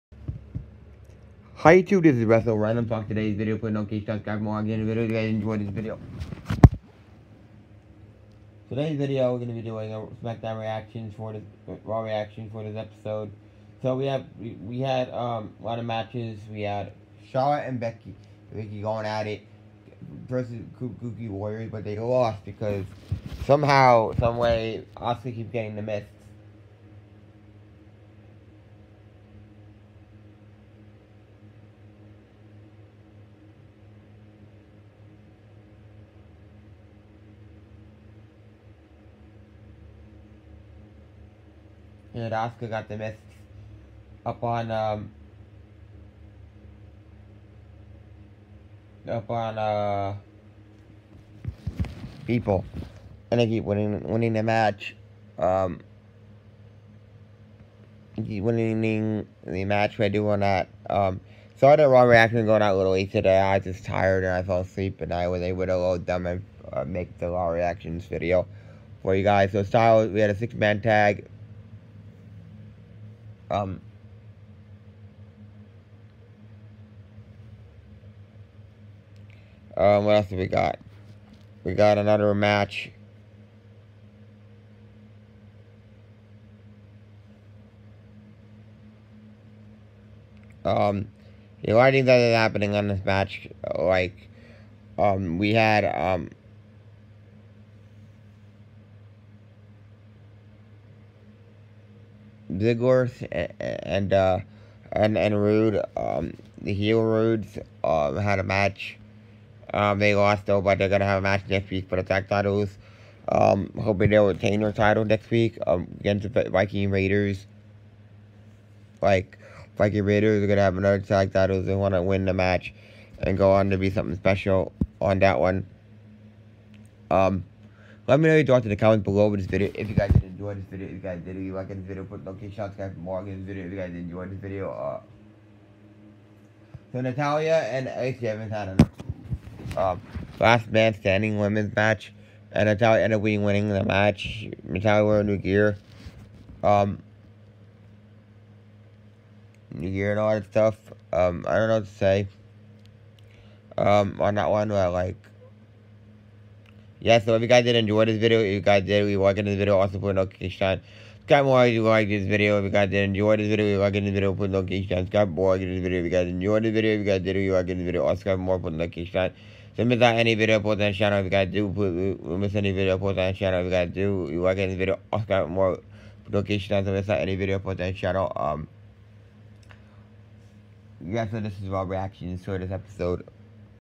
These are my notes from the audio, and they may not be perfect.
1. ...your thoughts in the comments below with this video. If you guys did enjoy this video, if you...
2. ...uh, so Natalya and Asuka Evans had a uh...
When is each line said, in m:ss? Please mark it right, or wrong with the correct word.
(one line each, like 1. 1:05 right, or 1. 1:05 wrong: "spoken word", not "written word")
1. 2:08 right
2. 2:14 wrong: "Ace", not "Asuka".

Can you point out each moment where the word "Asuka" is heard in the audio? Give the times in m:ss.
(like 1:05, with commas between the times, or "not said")
0:24, 0:42.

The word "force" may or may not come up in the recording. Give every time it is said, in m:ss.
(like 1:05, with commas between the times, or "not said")
not said.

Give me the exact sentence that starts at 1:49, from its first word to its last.
Um, they lost though, but they're gonna have a match next week for the tag titles.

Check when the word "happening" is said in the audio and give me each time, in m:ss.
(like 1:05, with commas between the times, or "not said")
1:32.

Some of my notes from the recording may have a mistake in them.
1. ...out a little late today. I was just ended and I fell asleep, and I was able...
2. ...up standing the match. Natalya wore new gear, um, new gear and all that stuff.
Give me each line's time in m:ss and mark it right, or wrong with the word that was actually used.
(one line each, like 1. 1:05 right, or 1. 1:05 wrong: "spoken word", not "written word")
1. 1:02 wrong: "tired", not "ended"
2. 2:23 wrong: "winning", not "standing".